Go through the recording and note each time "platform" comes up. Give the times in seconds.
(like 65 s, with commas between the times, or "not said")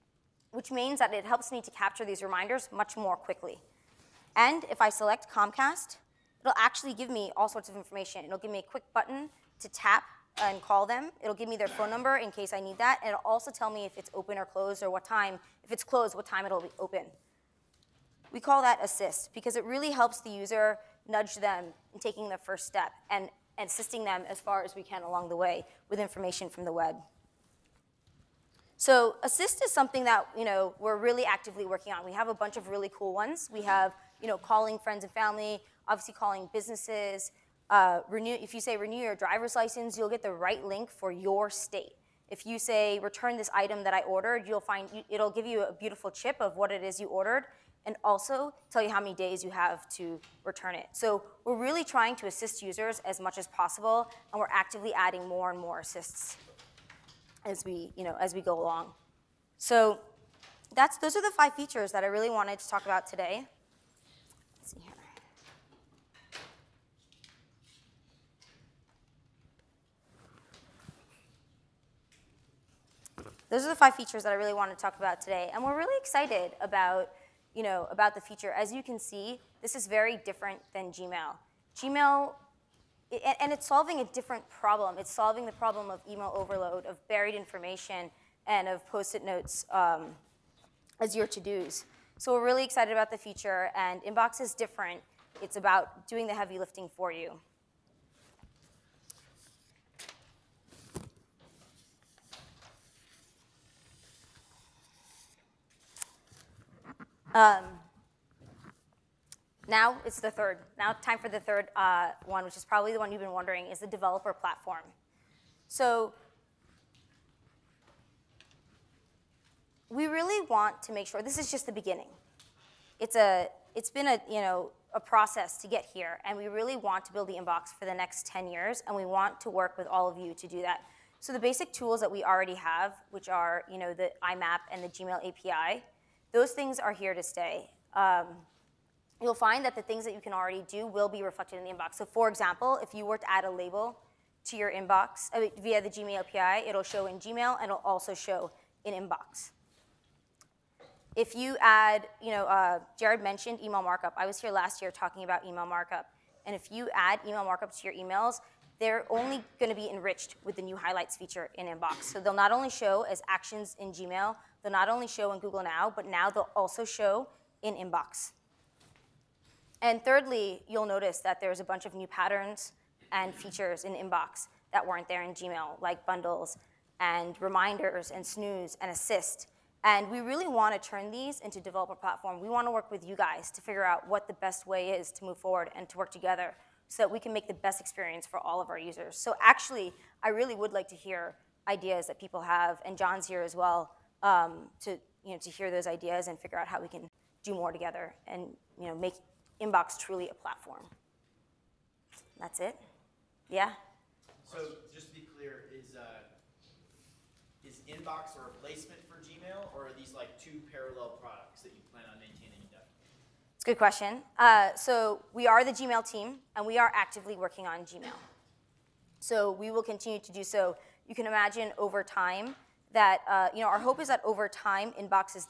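114 s, 181 s, 200 s.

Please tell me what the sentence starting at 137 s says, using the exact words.
Um, you'll find that the things that you can already do will be reflected in the inbox.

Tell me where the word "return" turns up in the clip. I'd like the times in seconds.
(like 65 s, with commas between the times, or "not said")
42 s, 50 s.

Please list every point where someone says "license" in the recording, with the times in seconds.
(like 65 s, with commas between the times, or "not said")
39 s.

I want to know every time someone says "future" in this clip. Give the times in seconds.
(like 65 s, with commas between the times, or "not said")
78 s, 93 s.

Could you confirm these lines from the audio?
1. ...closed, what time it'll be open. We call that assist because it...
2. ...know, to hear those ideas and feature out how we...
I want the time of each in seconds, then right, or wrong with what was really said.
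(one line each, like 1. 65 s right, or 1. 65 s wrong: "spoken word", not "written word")
1. 15 s right
2. 195 s wrong: "figure", not "feature".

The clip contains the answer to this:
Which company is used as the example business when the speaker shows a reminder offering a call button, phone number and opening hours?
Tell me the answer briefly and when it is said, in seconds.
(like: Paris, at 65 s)
Comcast, at 5 s.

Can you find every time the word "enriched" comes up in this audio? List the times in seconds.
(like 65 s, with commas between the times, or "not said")
159 s.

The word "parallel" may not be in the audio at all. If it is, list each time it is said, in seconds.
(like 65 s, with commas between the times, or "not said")
210 s.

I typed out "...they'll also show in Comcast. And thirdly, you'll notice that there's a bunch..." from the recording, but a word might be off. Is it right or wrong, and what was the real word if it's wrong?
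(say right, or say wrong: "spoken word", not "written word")
wrong: "Inbox", not "Comcast".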